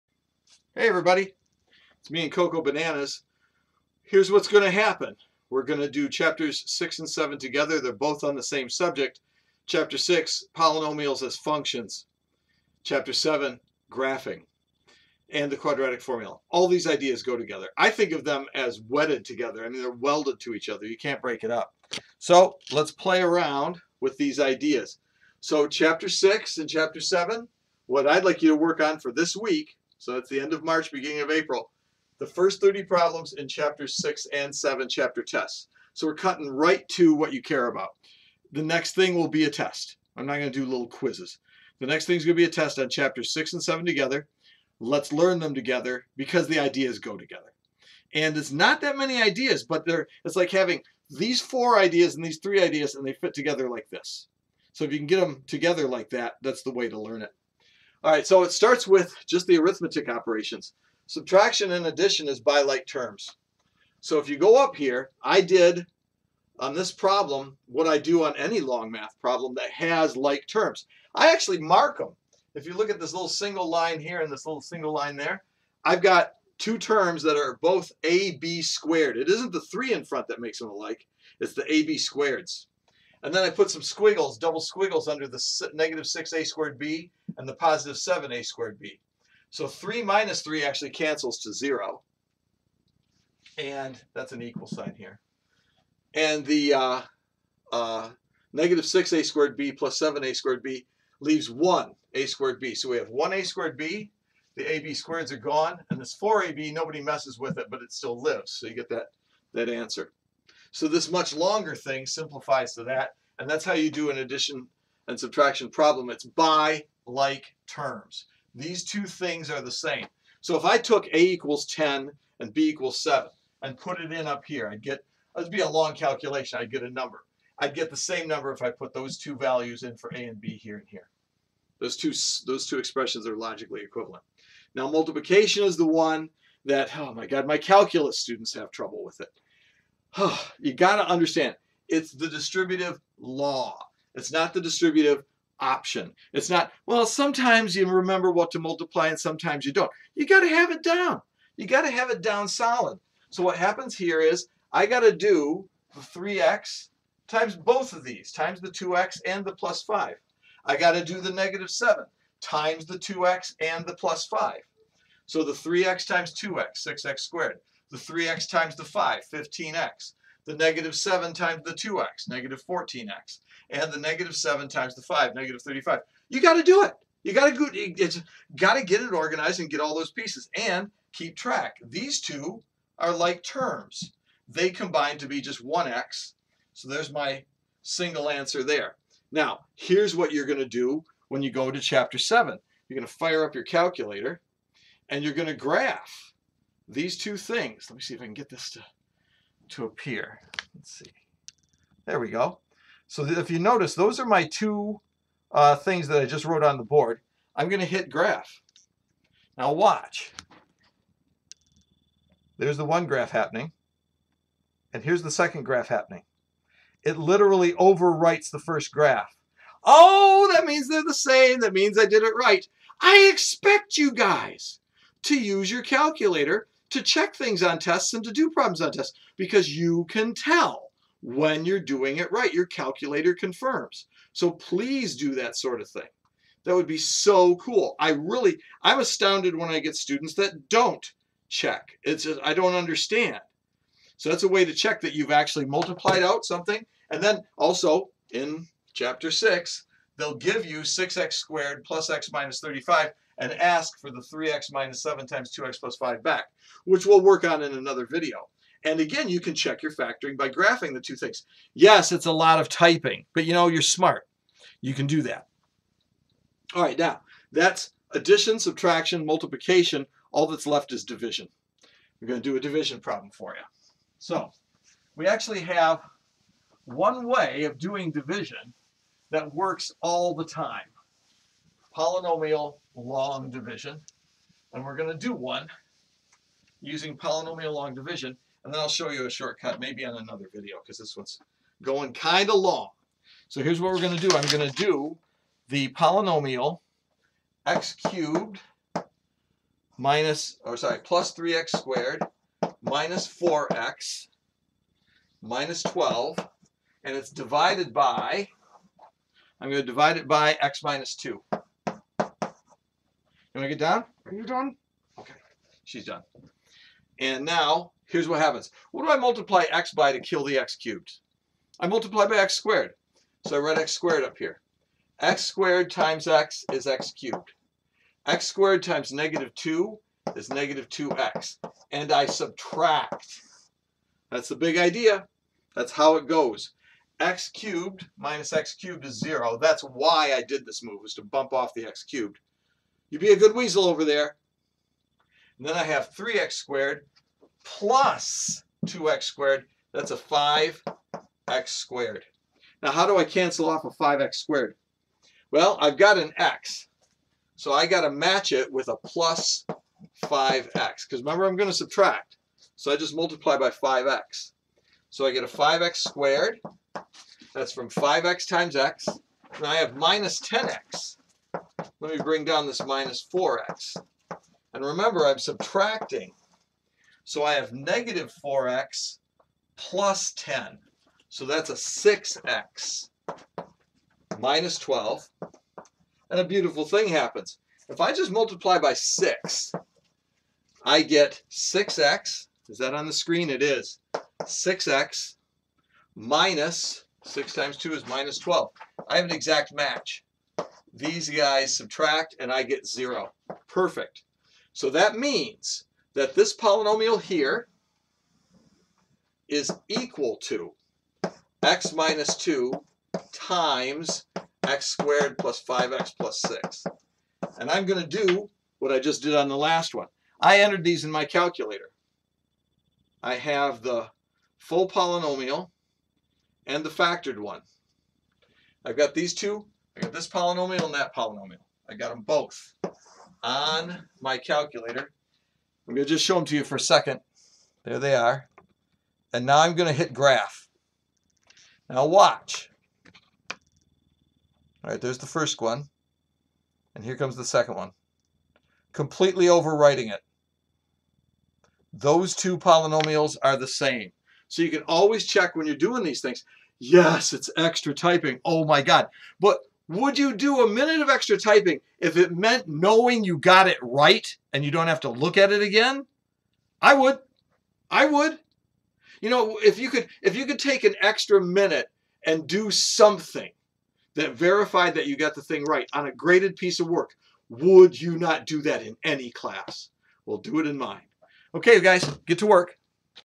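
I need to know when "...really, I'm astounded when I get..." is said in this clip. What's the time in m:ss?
3:58.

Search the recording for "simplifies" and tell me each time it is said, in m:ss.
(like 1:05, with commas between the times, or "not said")
1:52.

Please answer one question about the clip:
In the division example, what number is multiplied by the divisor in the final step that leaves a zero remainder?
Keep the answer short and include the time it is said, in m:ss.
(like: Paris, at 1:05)
6, at 6:28.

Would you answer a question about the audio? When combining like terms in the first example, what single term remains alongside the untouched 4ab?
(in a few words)
1a squared b.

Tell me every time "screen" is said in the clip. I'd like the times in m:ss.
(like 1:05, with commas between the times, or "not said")
6:33.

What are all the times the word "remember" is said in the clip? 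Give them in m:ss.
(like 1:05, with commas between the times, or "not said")
2:27, 6:01, 6:14.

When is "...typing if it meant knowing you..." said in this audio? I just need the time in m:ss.
7:41.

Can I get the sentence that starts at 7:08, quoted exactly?
I've got these two I got this polynomial and that polynomial.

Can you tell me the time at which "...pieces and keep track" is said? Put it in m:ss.
3:00.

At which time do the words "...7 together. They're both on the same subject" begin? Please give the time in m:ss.
0:07.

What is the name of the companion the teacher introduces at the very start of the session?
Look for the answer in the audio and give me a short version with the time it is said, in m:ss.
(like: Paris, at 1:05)
Cocoa Bananas, at 0:02.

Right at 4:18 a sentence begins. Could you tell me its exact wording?
And again, you can check your factoring by graphing the two things.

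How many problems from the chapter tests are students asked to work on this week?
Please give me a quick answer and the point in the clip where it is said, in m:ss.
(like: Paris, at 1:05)
30, at 0:32.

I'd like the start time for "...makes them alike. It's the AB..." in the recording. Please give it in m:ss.
1:20.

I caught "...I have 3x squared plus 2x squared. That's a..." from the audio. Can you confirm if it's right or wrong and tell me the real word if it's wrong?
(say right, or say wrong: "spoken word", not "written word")
right.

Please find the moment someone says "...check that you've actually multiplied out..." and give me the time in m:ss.
4:04.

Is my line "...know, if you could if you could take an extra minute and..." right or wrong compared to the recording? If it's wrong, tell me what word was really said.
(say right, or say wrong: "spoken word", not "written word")
right.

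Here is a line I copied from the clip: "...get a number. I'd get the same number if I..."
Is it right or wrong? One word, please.
right.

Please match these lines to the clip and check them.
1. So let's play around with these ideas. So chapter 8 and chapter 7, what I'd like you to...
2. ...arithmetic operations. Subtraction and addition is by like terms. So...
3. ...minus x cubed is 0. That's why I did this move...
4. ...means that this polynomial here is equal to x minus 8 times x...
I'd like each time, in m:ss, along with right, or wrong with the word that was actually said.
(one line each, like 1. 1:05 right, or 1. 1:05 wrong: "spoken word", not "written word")
1. 0:22 wrong: "6", not "8"
2. 0:59 right
3. 5:38 right
4. 6:45 wrong: "2", not "8".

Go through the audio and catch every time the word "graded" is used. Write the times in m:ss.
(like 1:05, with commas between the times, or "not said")
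7:56.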